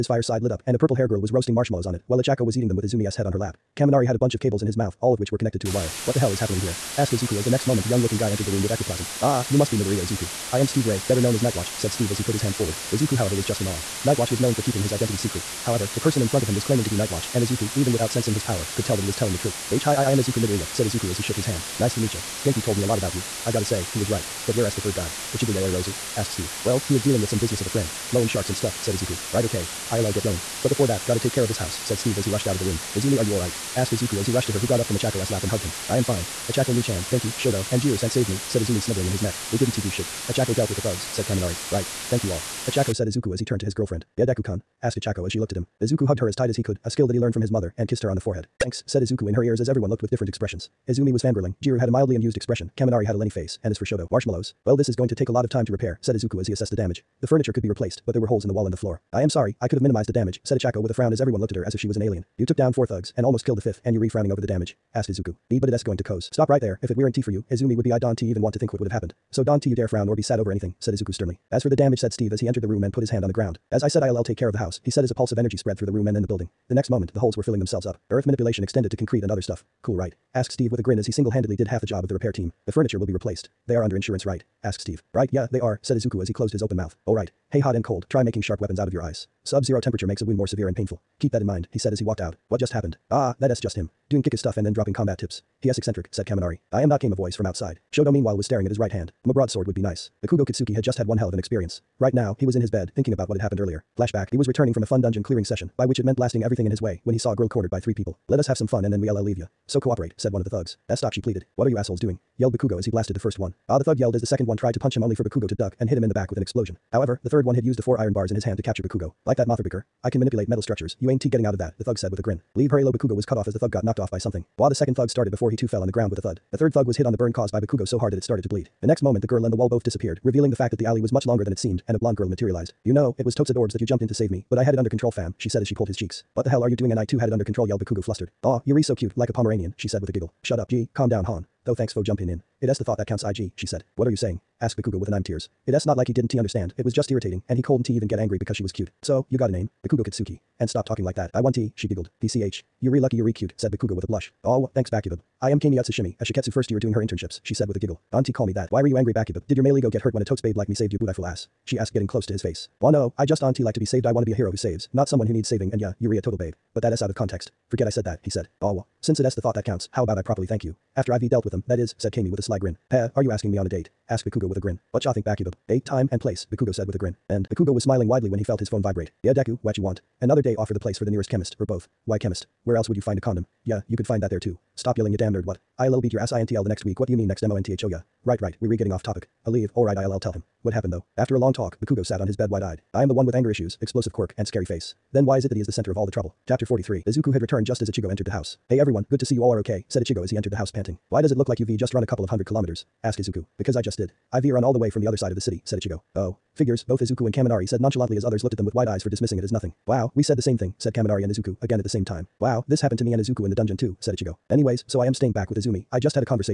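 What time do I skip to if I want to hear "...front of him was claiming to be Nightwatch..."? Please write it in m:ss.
0:16.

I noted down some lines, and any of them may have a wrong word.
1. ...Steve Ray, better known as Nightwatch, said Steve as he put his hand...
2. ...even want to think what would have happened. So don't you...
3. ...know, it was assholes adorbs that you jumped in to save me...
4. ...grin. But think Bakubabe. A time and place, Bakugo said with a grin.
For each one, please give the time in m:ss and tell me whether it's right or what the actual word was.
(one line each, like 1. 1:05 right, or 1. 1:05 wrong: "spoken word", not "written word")
1. 0:10 right
2. 1:08 right
3. 2:12 wrong: "totes", not "assholes"
4. 2:54 right.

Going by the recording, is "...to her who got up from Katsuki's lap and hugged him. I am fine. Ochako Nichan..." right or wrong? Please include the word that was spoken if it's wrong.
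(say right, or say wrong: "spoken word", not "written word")
wrong: "Ochako", not "Katsuki".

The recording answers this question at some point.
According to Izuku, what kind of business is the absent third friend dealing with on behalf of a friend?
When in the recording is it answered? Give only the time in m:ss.
0:28.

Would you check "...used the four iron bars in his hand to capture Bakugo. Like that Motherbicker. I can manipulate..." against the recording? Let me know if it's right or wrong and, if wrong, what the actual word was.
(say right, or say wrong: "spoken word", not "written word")
right.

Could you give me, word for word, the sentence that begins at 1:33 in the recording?
Ah, that's just him doing Kika stuff and then dropping combat tips.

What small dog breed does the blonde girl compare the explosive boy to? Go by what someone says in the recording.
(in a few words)
Pomeranian.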